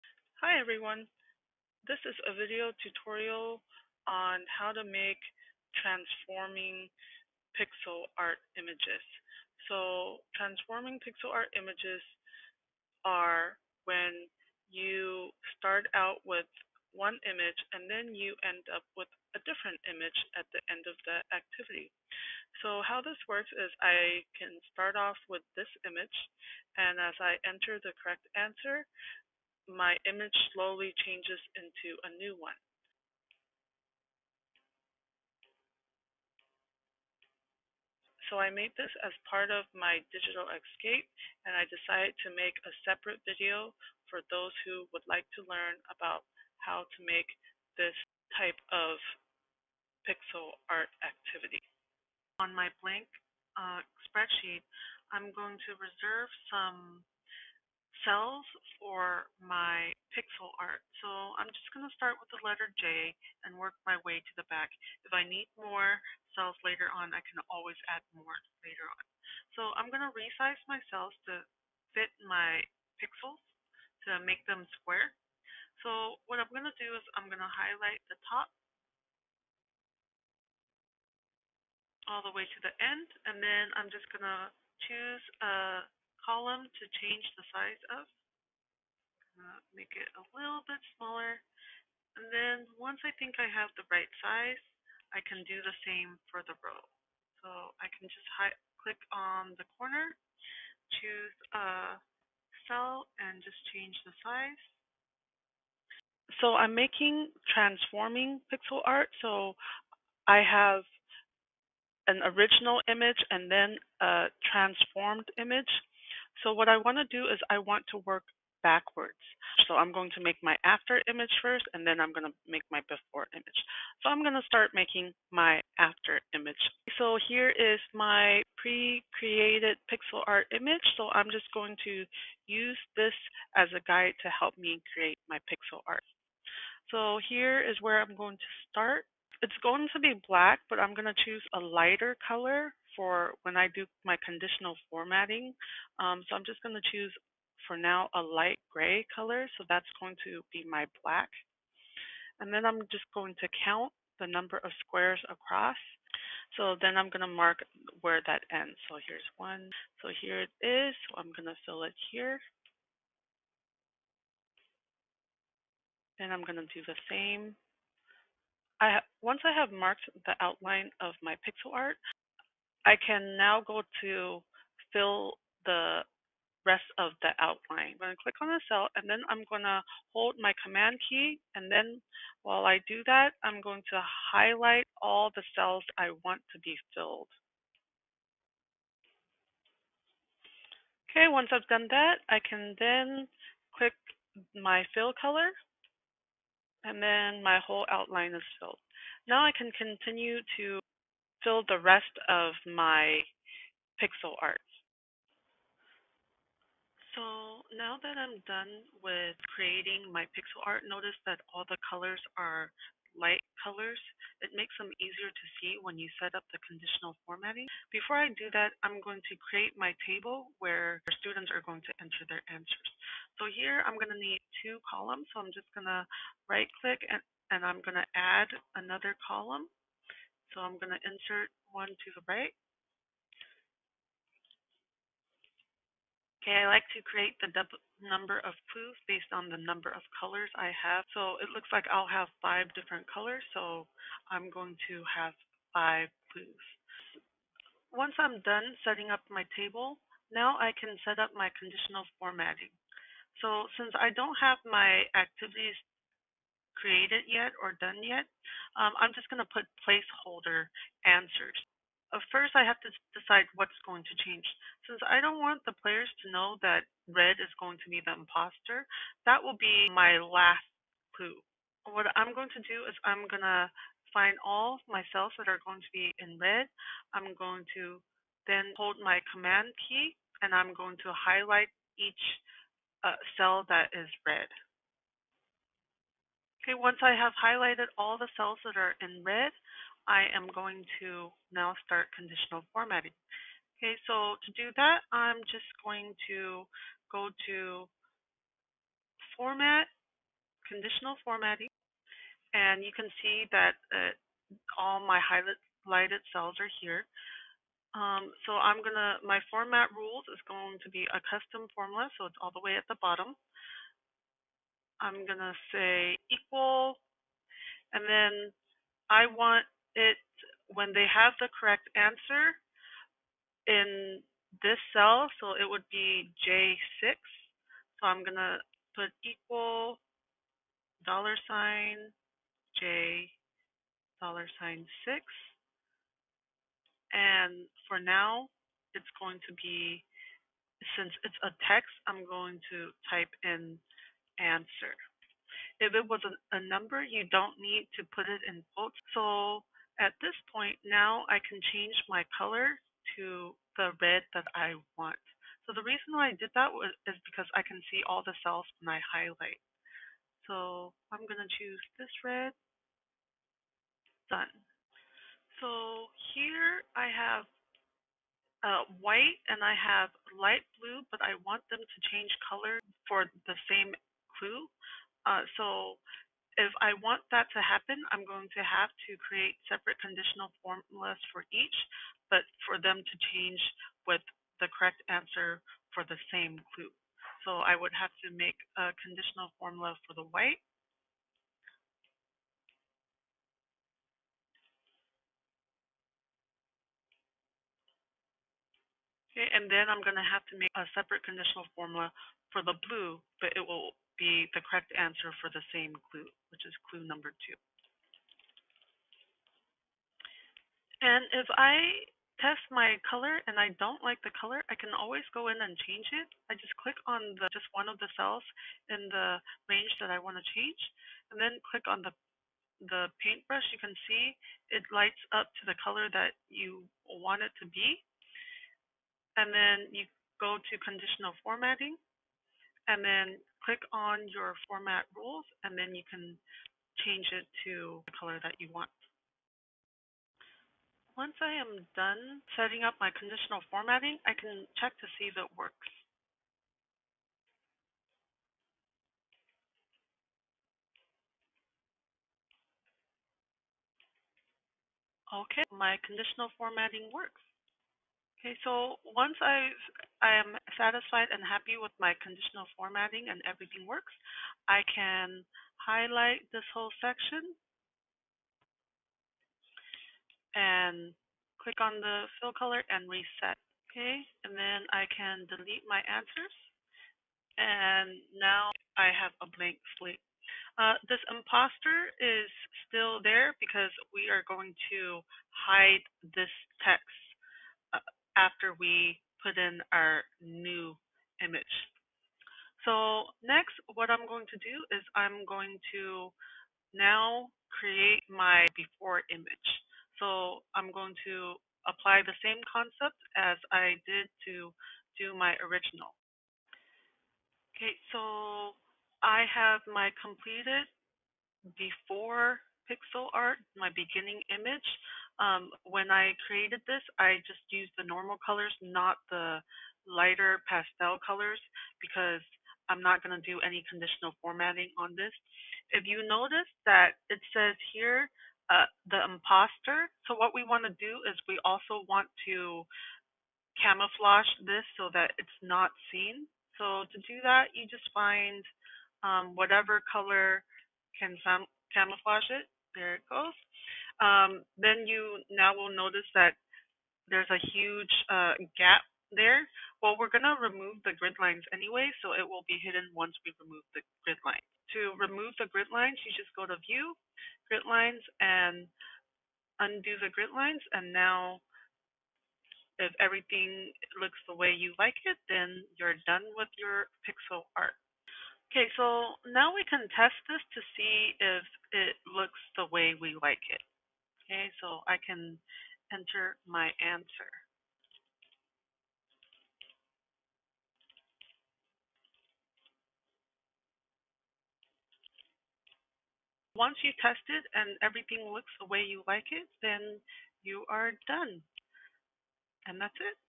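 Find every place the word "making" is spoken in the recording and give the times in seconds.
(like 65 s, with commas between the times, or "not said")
106 s, 124 s.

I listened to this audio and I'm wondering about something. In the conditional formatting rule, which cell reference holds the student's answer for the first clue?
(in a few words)
J6.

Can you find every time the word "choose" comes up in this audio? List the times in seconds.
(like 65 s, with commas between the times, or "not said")
84 s, 101 s, 141 s, 146 s, 361 s.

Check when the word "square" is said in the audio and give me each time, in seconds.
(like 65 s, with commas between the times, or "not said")
74 s, 154 s.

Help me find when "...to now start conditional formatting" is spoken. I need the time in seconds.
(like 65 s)
291 s.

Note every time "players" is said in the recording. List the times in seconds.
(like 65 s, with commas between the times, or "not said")
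265 s.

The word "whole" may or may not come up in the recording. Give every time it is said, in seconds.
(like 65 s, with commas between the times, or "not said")
197 s, 466 s.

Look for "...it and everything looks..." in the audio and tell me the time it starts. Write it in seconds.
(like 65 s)
587 s.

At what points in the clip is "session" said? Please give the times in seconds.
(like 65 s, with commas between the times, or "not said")
not said.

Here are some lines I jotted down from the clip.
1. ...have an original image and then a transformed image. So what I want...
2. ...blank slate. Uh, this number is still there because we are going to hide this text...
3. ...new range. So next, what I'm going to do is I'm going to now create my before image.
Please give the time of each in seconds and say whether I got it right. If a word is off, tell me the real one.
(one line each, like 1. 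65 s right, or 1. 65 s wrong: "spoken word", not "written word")
1. 110 s right
2. 479 s wrong: "imposter", not "number"
3. 490 s wrong: "image", not "range".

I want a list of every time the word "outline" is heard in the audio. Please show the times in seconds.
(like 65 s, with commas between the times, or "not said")
170 s, 177 s, 197 s.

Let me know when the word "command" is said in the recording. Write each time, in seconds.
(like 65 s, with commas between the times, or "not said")
180 s, 279 s.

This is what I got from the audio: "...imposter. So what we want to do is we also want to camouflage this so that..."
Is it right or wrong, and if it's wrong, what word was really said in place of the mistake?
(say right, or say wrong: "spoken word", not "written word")
right.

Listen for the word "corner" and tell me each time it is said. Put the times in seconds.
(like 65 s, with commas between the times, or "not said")
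99 s.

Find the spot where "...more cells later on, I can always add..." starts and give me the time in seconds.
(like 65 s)
65 s.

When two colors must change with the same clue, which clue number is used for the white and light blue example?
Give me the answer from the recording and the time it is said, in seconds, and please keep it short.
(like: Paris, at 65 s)
2, at 406 s.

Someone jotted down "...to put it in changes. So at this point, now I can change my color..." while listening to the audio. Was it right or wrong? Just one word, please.
wrong.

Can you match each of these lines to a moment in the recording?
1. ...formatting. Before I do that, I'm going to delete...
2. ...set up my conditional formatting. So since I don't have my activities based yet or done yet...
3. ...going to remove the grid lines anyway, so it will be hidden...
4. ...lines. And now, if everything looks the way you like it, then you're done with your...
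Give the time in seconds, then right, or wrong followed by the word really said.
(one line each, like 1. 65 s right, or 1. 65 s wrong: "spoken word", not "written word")
1. 217 s wrong: "create", not "delete"
2. 251 s wrong: "created", not "based"
3. 550 s right
4. 560 s right.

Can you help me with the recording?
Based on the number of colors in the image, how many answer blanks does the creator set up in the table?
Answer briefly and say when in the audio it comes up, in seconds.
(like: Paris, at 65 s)
5, at 245 s.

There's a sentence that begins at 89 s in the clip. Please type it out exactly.
Uh, make it a little bit smaller.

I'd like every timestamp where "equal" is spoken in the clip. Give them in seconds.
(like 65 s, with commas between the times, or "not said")
316 s, 329 s.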